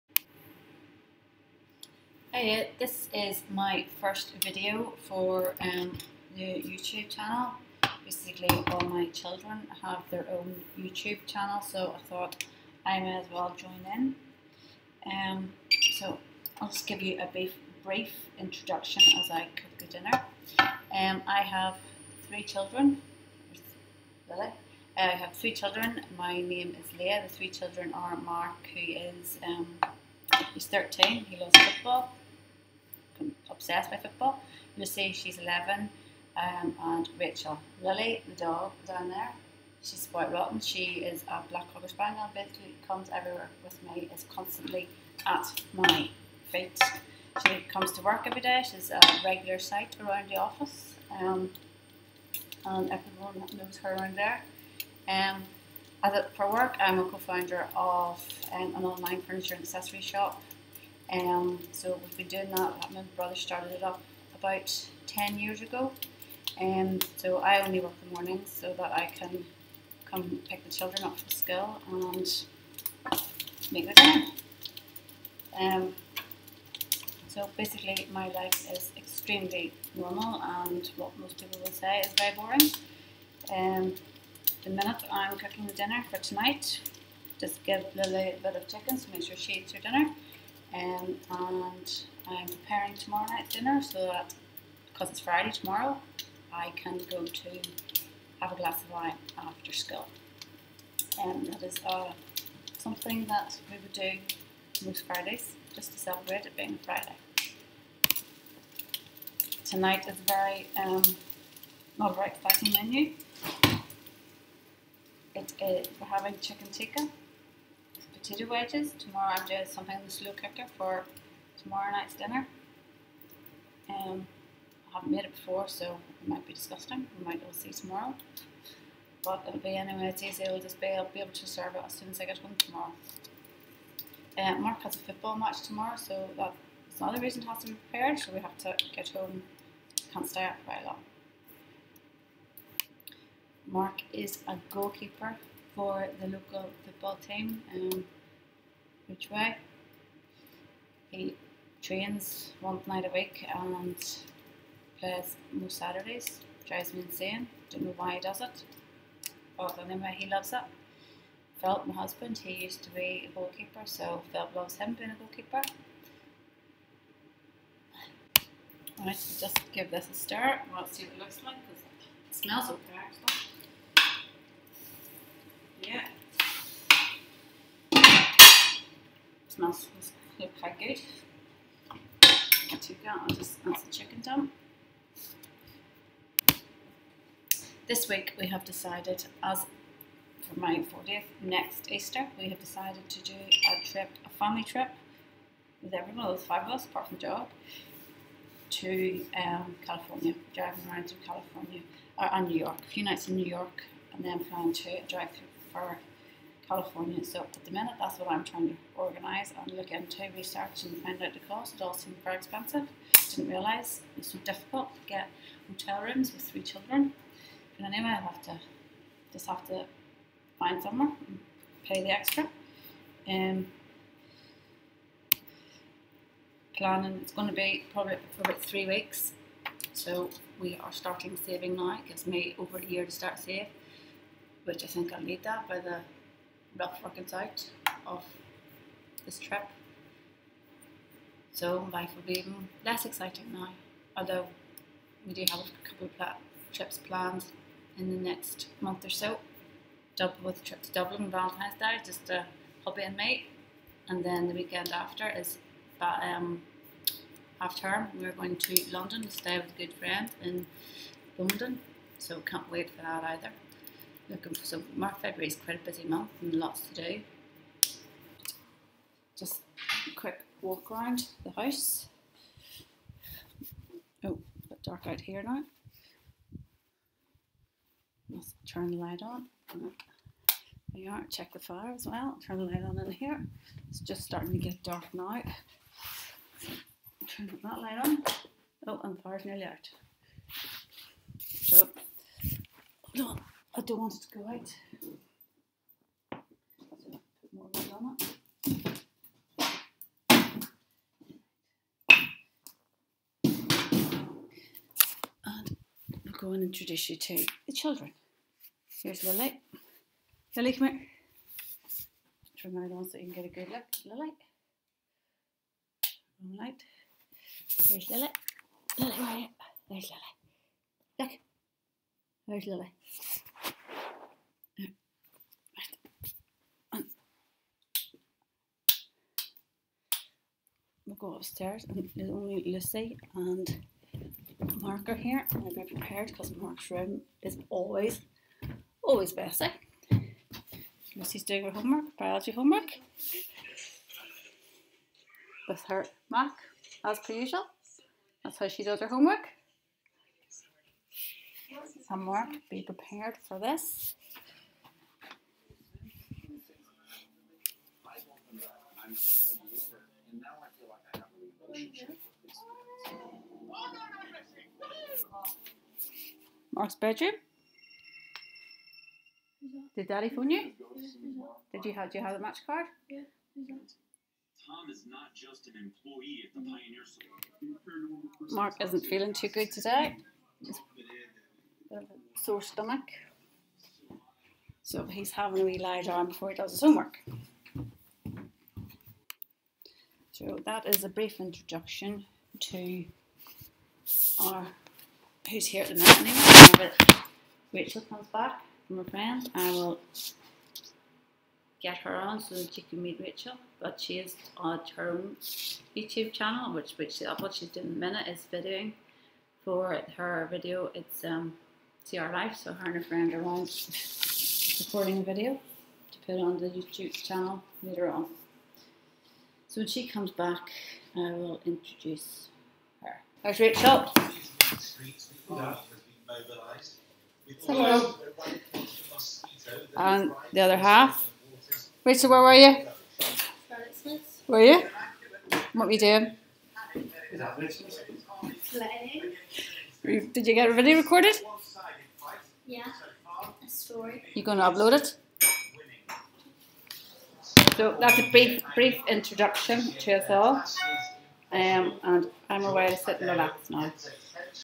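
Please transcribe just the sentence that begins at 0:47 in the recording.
She comes to work every day, she's a regular sight around the office, um, and everyone knows her around there.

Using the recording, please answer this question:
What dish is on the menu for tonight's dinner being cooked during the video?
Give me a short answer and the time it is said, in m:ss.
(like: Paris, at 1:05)
Chicken tikka, at 1:56.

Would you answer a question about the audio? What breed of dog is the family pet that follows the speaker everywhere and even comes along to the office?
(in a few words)
Cocker spaniel.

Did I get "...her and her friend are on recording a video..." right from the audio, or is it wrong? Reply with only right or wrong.
right.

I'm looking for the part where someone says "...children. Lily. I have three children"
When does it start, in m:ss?
0:22.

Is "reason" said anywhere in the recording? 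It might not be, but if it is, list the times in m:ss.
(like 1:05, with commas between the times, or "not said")
2:17.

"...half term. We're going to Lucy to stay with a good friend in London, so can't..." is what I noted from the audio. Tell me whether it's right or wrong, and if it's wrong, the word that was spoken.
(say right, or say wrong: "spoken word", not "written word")
wrong: "London", not "Lucy".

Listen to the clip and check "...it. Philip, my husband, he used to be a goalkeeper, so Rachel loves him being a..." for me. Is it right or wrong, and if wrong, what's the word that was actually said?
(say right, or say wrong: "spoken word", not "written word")
wrong: "Philip", not "Rachel".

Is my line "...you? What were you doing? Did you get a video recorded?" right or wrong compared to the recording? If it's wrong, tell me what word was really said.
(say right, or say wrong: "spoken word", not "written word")
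right.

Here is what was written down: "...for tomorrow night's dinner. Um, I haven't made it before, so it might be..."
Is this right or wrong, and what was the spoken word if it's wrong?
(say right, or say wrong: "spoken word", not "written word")
right.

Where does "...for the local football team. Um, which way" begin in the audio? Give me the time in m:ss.
2:25.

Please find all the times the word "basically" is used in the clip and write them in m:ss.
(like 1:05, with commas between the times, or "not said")
0:08, 0:42, 1:17.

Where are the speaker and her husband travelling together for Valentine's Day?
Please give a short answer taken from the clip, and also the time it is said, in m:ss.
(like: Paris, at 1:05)
Dublin, at 4:10.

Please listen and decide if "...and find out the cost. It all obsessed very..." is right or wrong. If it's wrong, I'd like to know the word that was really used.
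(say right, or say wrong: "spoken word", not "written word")
wrong: "seemed", not "obsessed".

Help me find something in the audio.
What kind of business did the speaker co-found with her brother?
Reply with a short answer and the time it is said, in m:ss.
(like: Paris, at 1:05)
Online furniture and accessory shop, at 0:58.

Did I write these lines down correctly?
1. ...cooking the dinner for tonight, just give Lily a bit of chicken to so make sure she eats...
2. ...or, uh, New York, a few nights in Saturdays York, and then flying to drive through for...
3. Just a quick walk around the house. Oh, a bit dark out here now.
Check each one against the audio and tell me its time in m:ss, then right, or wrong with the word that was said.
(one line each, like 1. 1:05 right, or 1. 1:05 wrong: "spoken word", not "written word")
1. 1:25 right
2. 3:22 wrong: "New", not "Saturdays"
3. 4:29 right.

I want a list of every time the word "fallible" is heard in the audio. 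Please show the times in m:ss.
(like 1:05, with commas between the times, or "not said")
not said.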